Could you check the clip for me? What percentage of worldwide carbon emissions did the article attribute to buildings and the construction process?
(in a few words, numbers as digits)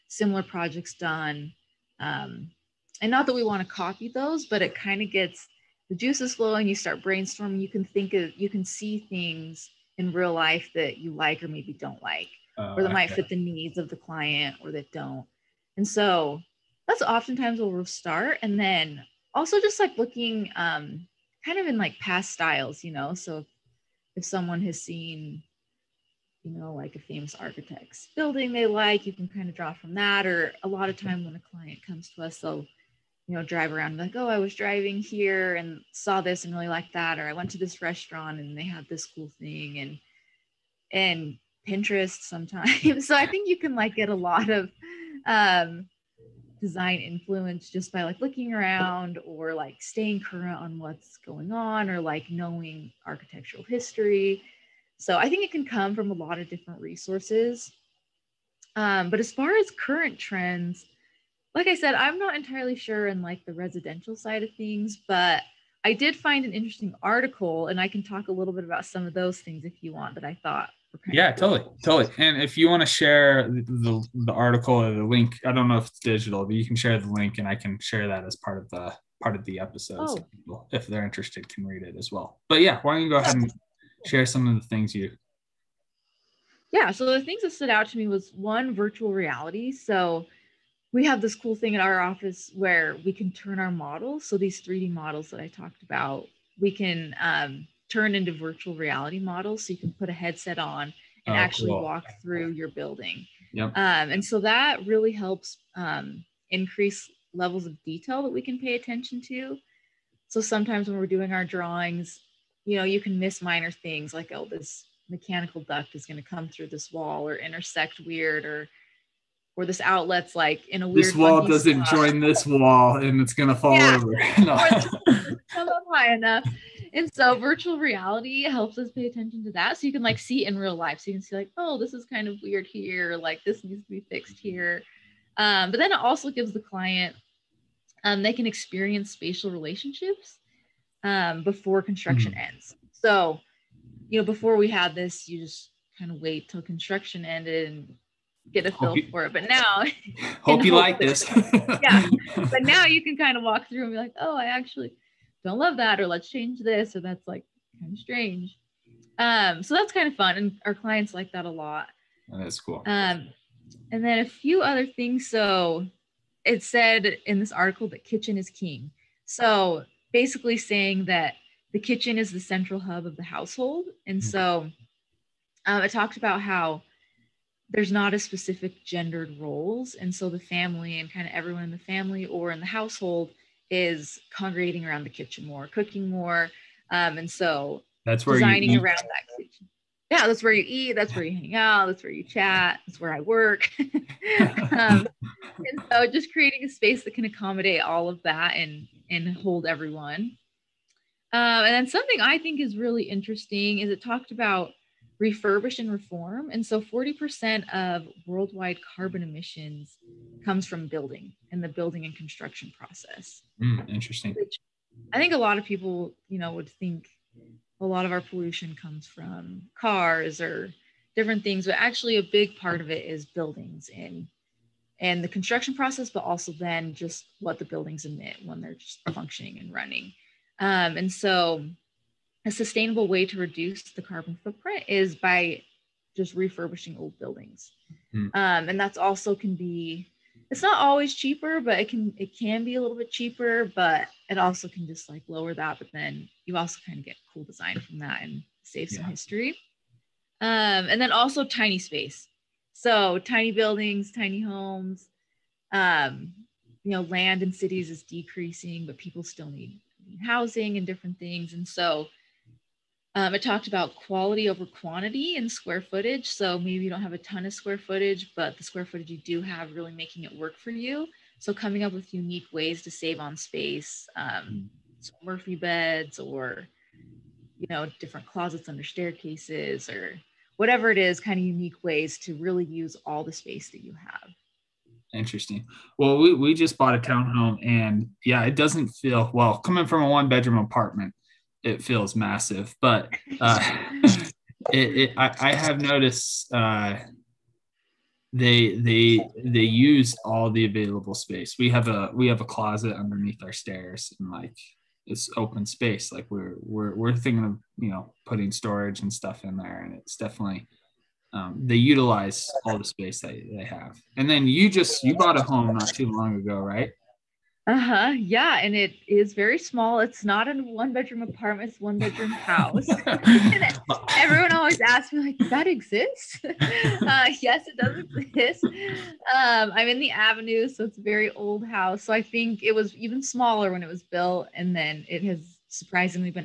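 40%.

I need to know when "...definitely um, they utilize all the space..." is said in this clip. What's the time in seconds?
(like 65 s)
310 s.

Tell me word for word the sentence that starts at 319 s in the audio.
It's not a one bedroom apartment, it's one bedroom house.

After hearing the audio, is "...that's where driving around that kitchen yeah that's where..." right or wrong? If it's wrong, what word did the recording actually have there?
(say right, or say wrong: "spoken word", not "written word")
wrong: "designing", not "driving".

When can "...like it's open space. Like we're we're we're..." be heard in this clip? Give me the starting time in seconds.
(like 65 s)
304 s.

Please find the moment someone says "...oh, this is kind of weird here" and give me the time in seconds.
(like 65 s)
131 s.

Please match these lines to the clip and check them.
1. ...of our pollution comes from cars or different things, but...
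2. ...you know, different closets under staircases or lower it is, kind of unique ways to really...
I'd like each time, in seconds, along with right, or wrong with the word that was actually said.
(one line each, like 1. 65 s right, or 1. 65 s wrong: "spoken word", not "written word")
1. 218 s right
2. 277 s wrong: "whatever", not "lower".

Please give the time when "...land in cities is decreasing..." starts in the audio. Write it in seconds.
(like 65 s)
257 s.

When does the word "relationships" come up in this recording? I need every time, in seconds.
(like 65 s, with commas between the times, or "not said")
139 s.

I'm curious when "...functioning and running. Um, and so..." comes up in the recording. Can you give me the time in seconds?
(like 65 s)
229 s.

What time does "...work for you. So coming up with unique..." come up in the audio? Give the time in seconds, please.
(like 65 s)
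270 s.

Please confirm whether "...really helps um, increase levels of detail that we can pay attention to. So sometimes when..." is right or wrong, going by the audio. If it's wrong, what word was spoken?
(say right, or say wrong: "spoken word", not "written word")
right.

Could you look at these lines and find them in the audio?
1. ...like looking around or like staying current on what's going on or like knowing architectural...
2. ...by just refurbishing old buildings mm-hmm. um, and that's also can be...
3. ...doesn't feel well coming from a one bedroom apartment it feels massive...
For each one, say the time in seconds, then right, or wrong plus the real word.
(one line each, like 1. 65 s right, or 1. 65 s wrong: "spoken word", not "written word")
1. 48 s right
2. 235 s right
3. 288 s right.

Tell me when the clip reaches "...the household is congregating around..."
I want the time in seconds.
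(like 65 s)
182 s.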